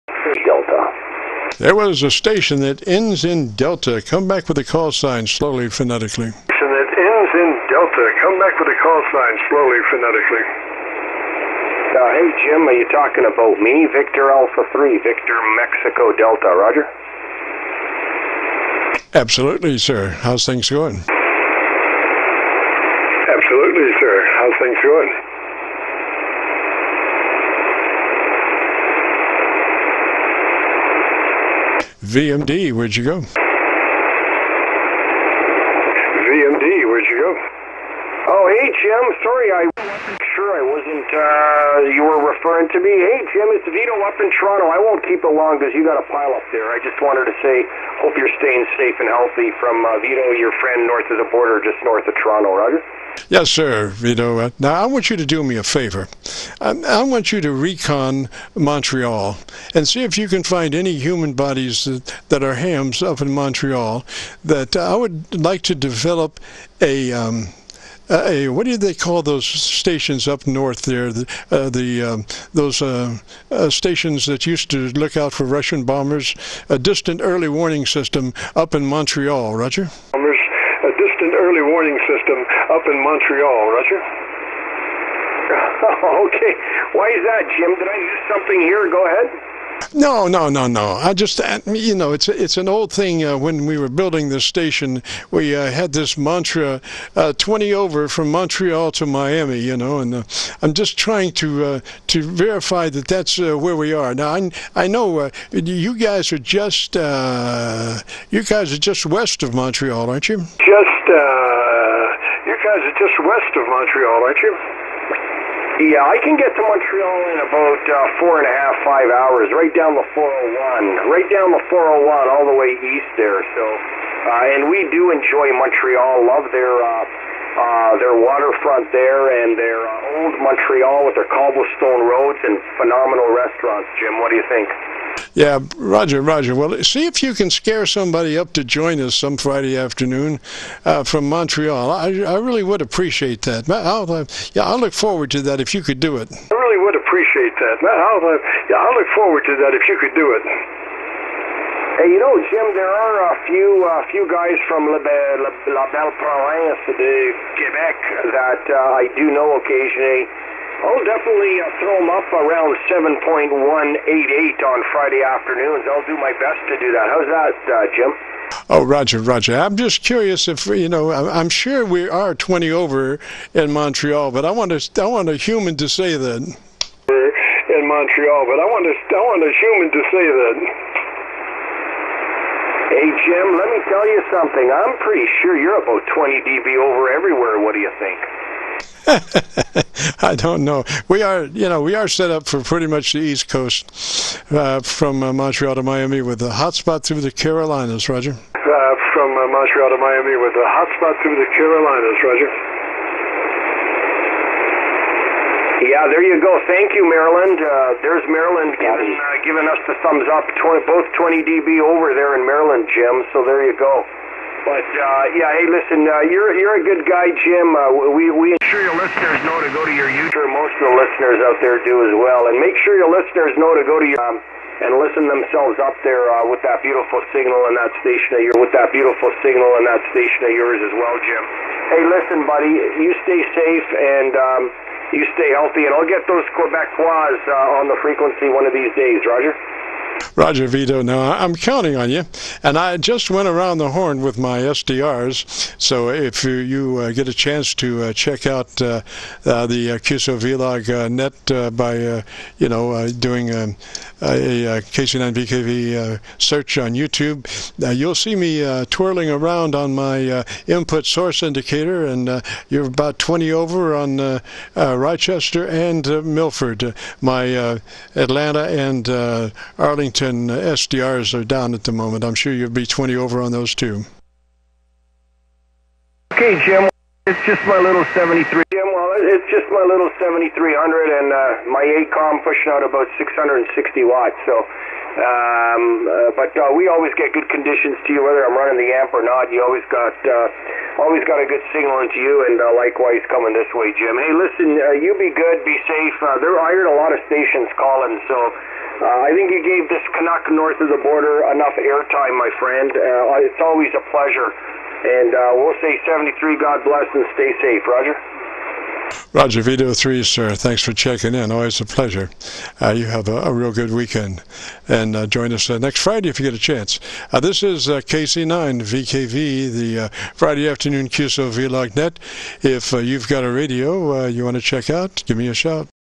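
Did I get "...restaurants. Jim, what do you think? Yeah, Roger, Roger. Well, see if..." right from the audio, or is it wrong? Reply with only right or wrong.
right.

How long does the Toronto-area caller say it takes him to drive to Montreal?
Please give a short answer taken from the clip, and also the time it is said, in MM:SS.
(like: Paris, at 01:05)
4.5 to 5 hours, at 01:58.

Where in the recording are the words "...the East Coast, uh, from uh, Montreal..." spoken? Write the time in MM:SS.
03:13.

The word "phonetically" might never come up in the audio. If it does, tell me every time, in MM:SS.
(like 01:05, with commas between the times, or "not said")
00:05, 00:09.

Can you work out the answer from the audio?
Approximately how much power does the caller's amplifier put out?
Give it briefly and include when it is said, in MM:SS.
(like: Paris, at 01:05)
660 watts, at 04:43.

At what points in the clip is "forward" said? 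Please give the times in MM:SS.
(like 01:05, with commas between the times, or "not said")
02:24, 02:29.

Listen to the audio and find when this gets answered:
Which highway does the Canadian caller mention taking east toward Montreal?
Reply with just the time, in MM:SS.
01:59.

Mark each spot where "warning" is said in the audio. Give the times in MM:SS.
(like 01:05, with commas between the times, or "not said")
01:17, 01:21.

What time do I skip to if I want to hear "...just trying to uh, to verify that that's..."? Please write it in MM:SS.
01:40.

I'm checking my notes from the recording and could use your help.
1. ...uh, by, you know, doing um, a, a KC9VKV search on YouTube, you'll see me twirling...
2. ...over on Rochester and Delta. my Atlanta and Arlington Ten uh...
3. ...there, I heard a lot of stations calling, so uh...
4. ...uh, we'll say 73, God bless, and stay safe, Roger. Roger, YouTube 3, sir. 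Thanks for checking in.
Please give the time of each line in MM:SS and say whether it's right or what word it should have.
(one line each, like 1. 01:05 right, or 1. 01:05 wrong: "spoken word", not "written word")
1. 04:11 right
2. 04:23 wrong: "Milford", not "Delta"
3. 04:56 right
4. 05:05 wrong: "Vito", not "YouTube".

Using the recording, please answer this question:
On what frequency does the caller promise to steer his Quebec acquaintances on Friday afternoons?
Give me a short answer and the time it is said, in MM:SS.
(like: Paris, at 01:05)
7.188, at 02:42.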